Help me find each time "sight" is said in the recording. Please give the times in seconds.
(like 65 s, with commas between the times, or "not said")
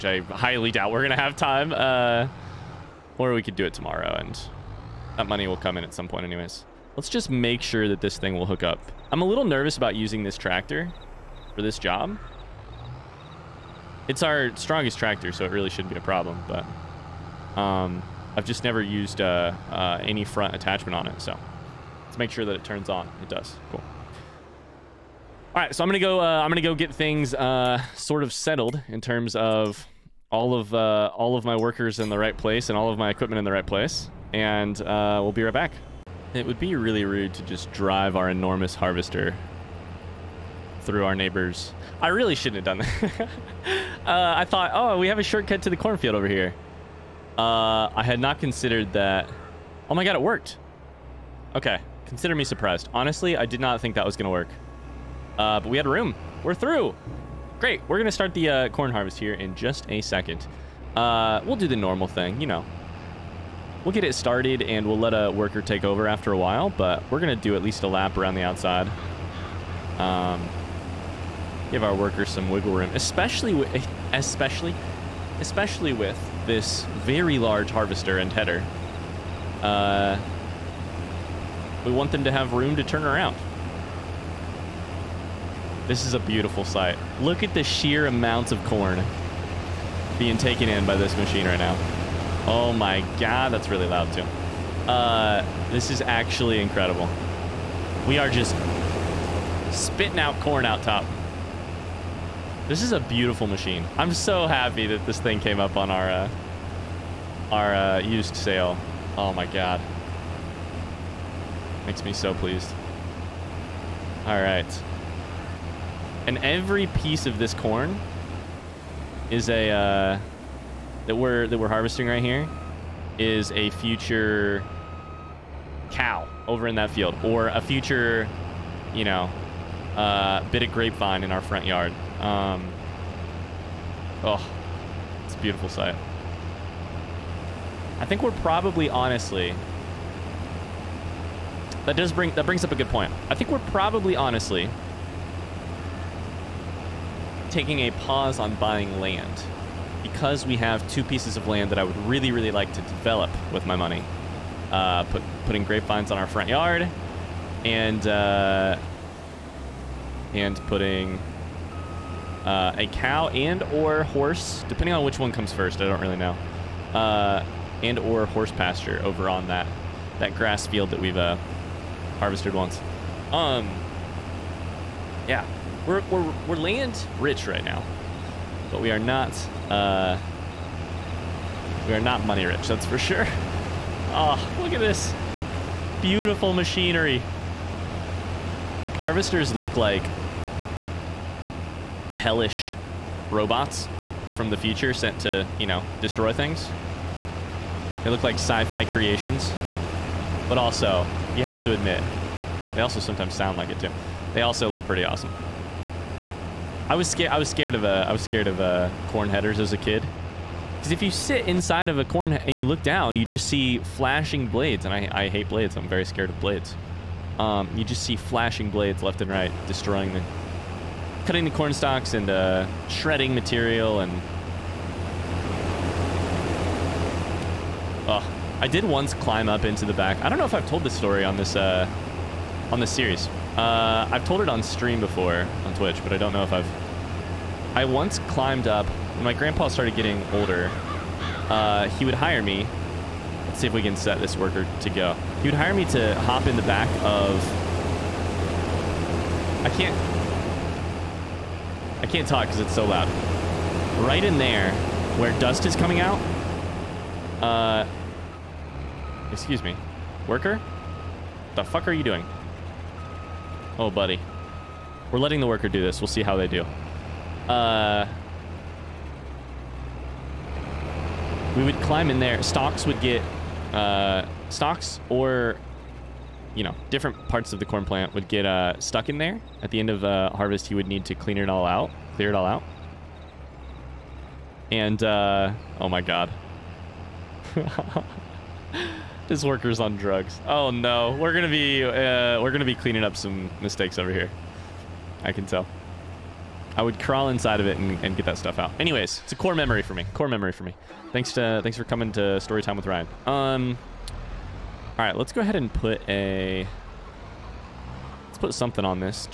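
86 s, 135 s.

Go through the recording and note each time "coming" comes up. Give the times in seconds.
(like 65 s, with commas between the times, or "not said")
255 s, 301 s.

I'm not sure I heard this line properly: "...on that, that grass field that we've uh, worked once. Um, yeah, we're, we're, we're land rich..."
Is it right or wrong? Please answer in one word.
wrong.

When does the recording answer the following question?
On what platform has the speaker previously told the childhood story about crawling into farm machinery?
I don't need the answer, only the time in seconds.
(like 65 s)
235 s.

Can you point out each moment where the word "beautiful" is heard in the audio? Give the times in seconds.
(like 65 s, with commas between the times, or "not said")
86 s, 103 s, 135 s, 186 s.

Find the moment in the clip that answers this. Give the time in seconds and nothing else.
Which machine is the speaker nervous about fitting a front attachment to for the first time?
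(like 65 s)
14 s.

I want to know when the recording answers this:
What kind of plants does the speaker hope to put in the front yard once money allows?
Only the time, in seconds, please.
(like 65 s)
155 s.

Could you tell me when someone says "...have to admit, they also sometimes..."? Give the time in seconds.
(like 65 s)
201 s.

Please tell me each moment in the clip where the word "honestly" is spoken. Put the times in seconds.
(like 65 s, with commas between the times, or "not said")
52 s, 138 s, 144 s.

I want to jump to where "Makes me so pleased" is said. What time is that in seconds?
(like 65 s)
111 s.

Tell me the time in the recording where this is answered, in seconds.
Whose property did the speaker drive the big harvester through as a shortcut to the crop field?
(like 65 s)
41 s.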